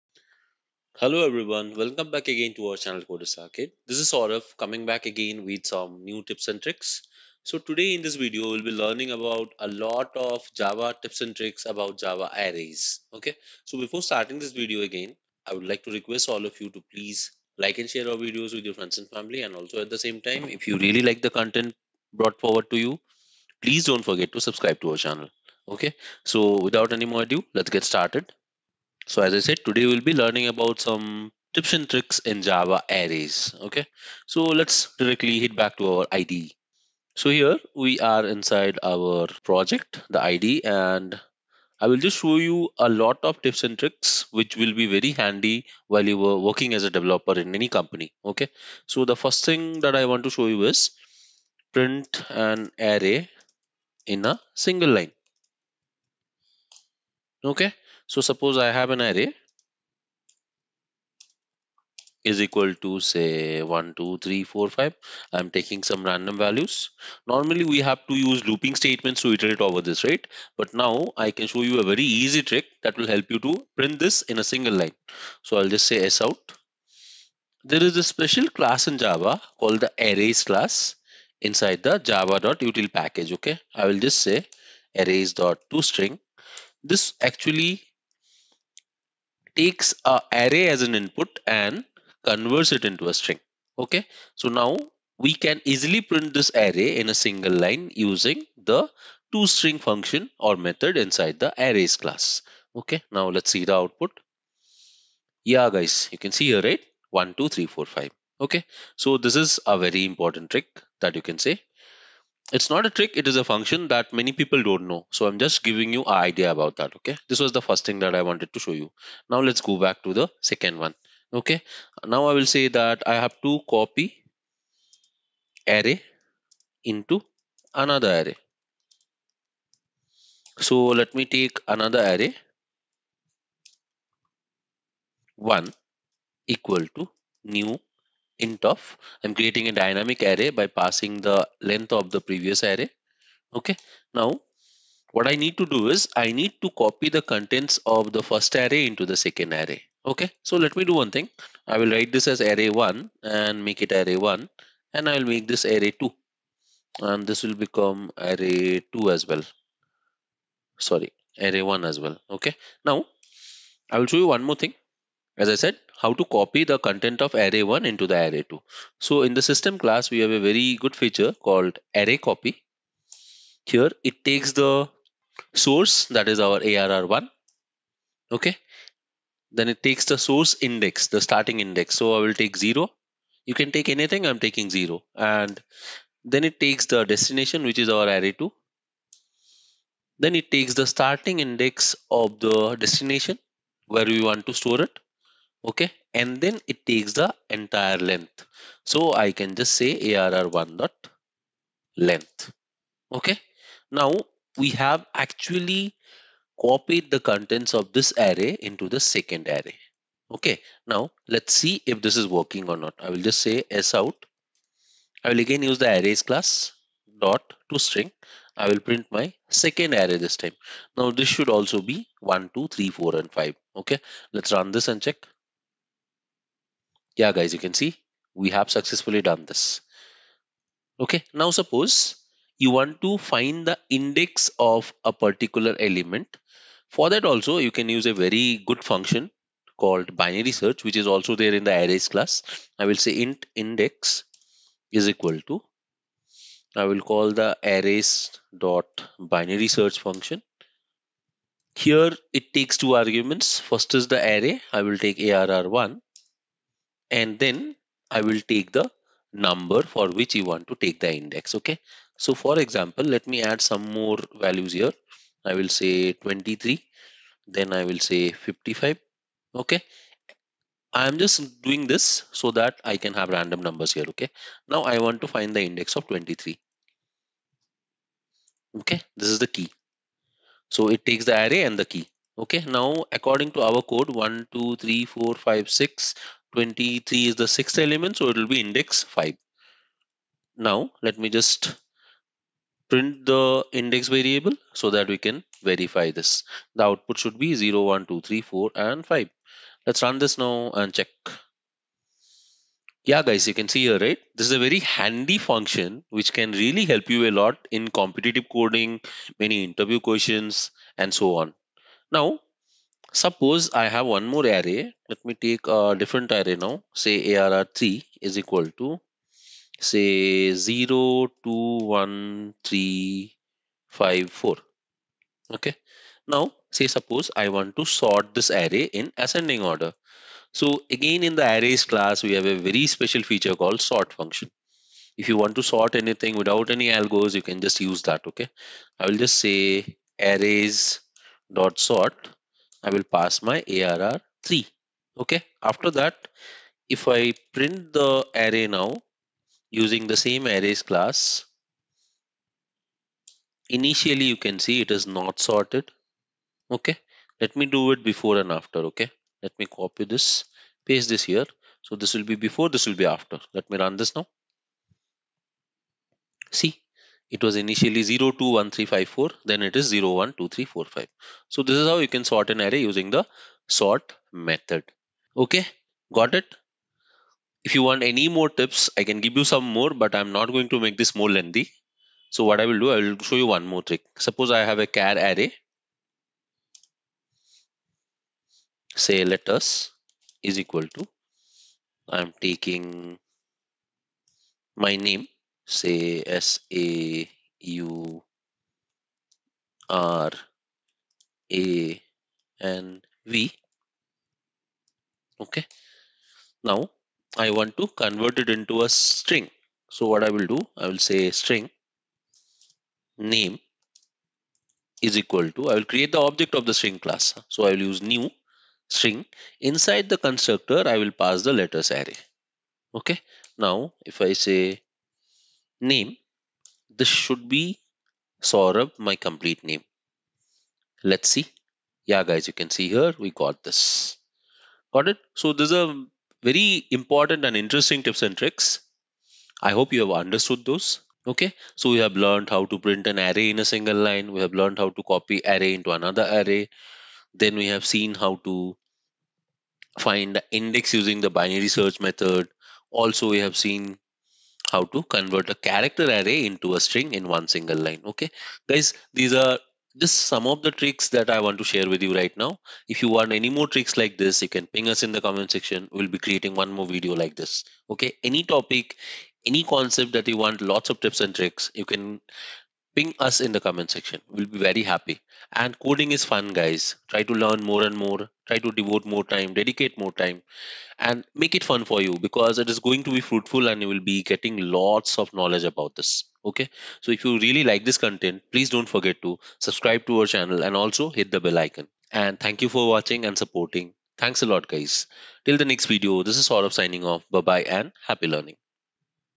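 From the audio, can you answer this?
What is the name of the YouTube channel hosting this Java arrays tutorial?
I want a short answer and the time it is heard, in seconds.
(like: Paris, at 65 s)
Coders Arcade, at 3 s.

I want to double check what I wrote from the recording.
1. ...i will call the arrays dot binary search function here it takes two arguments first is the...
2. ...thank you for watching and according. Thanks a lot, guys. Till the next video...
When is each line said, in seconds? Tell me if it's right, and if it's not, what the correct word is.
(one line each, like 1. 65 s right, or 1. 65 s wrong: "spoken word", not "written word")
1. 246 s right
2. 492 s wrong: "supporting", not "according".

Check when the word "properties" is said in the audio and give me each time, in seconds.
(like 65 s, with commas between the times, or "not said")
not said.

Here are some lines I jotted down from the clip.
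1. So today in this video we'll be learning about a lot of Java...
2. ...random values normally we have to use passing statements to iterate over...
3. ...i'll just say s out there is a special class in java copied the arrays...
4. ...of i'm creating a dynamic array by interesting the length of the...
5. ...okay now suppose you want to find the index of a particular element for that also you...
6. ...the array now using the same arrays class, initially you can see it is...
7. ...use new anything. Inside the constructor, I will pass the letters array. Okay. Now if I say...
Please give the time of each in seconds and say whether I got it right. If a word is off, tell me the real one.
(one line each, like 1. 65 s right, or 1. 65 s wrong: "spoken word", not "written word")
1. 7 s right
2. 66 s wrong: "looping", not "passing"
3. 75 s wrong: "called", not "copied"
4. 138 s wrong: "passing", not "interesting"
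5. 230 s right
6. 347 s right
7. 417 s wrong: "string", not "anything".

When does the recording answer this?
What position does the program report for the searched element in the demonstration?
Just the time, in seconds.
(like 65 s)
288 s.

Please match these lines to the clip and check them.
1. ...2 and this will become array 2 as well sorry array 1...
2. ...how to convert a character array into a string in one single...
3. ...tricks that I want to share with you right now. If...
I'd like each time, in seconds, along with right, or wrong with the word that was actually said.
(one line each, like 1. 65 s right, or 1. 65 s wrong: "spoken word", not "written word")
1. 156 s right
2. 454 s right
3. 460 s right.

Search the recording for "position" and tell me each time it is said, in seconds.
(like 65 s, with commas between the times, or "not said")
not said.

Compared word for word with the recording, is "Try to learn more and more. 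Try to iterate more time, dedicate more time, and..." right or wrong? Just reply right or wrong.
wrong.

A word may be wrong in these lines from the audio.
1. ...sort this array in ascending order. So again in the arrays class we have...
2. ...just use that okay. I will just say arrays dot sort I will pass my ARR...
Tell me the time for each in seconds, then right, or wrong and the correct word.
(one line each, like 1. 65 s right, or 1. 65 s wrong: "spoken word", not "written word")
1. 327 s right
2. 337 s right.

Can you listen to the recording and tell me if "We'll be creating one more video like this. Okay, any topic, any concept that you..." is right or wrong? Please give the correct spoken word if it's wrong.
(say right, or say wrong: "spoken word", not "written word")
right.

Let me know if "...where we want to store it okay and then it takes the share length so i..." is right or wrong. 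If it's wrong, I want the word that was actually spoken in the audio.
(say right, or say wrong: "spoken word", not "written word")
wrong: "entire", not "share".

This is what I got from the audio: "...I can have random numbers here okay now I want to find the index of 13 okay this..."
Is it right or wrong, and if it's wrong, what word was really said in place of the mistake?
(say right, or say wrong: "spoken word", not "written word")
wrong: "23", not "13".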